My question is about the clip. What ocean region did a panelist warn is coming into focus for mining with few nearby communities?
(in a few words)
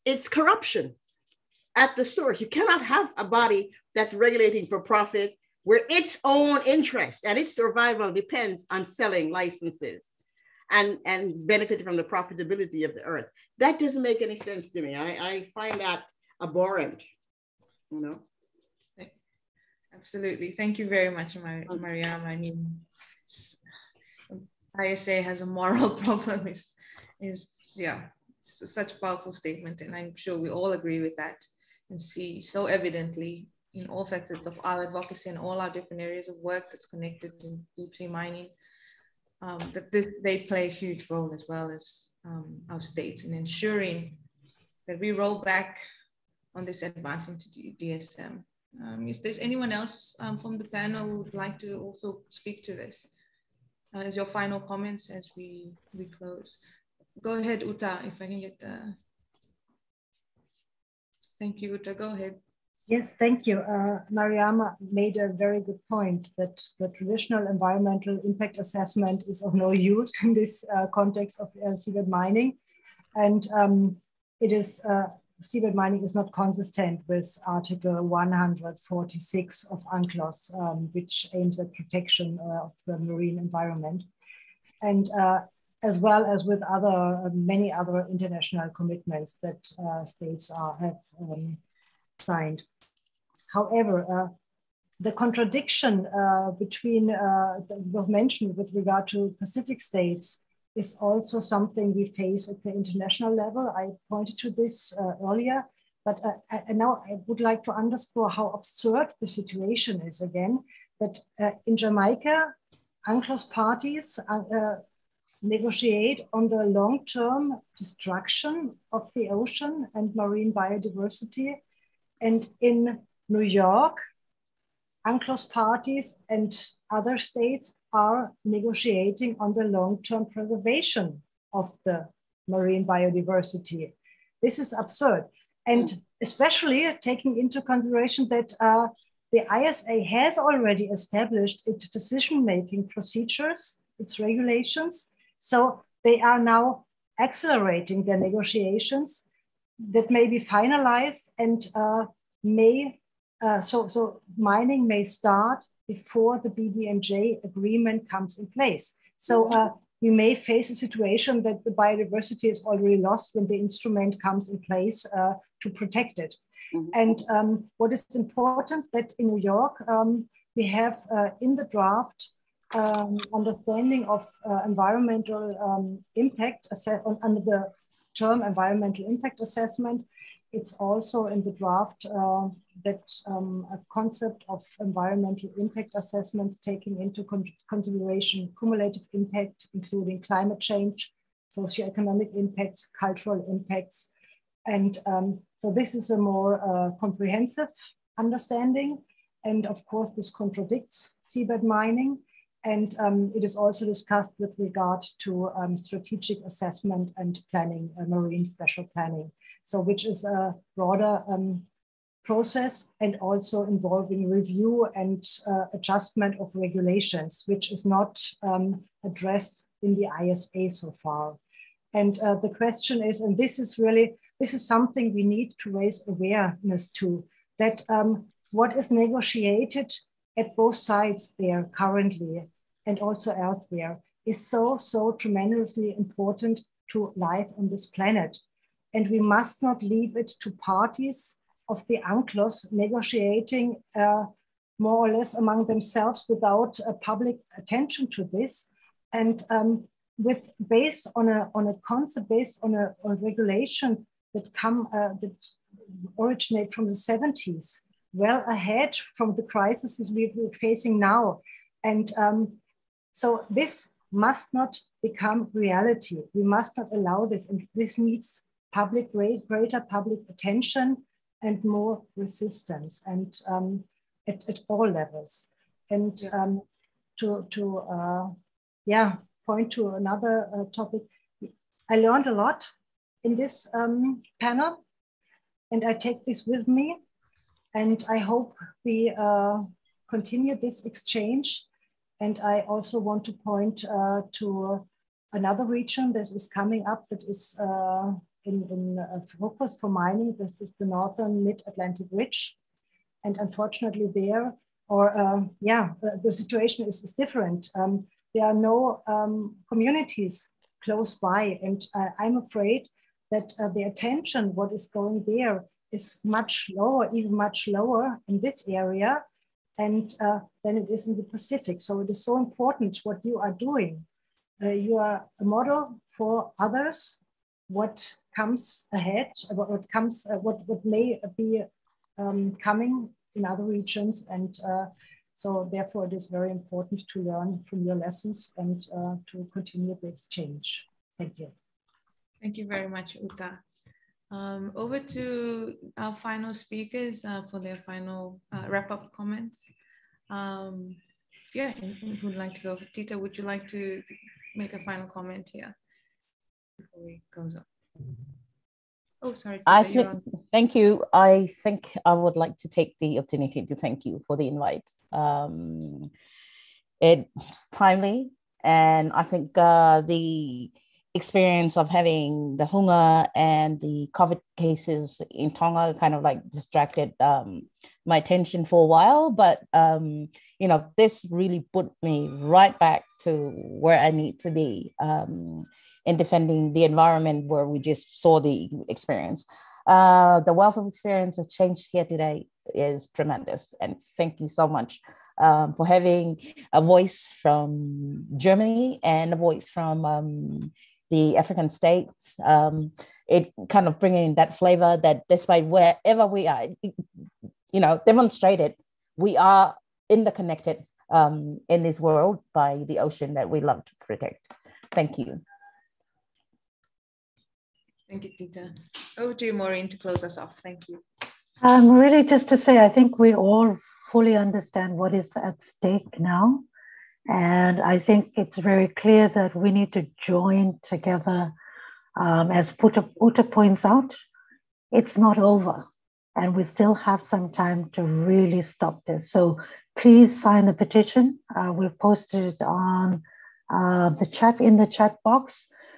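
northern mid-Atlantic ridge.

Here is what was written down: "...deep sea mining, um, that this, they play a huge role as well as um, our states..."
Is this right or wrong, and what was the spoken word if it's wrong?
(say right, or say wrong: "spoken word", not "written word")
right.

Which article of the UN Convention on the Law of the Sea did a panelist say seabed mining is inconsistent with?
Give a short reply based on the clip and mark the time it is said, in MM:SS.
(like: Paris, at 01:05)
Article 146, at 01:17.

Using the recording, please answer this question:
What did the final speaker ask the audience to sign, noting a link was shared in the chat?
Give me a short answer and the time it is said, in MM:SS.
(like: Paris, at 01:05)
the petition, at 07:20.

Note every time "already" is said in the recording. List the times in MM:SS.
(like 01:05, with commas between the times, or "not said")
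02:20, 02:42.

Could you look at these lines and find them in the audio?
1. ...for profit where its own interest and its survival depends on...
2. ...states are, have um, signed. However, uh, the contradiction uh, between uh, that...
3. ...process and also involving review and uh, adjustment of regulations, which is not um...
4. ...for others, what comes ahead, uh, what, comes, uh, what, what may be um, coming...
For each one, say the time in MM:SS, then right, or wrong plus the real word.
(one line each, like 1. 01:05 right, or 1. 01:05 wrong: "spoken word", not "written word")
1. 00:04 right
2. 01:30 right
3. 03:32 right
4. 05:26 right.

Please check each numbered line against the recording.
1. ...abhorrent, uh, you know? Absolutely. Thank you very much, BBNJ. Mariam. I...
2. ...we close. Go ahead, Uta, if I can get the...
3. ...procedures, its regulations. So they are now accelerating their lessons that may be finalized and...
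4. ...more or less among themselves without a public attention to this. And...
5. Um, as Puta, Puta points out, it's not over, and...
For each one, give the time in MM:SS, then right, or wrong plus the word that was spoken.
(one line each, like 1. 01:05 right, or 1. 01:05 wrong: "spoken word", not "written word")
1. 00:16 wrong: "Maria", not "BBNJ"
2. 00:55 right
3. 02:22 wrong: "negotiations", not "lessons"
4. 04:04 right
5. 07:12 right.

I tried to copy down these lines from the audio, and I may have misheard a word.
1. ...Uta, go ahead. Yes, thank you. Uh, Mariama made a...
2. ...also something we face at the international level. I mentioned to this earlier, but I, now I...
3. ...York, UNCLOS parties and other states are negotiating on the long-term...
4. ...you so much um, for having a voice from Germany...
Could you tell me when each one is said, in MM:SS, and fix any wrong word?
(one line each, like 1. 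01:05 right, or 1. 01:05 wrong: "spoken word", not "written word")
1. 01:01 right
2. 01:41 wrong: "pointed", not "mentioned"
3. 02:03 right
4. 06:34 right.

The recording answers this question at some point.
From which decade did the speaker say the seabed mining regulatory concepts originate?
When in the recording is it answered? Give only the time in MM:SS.
04:16.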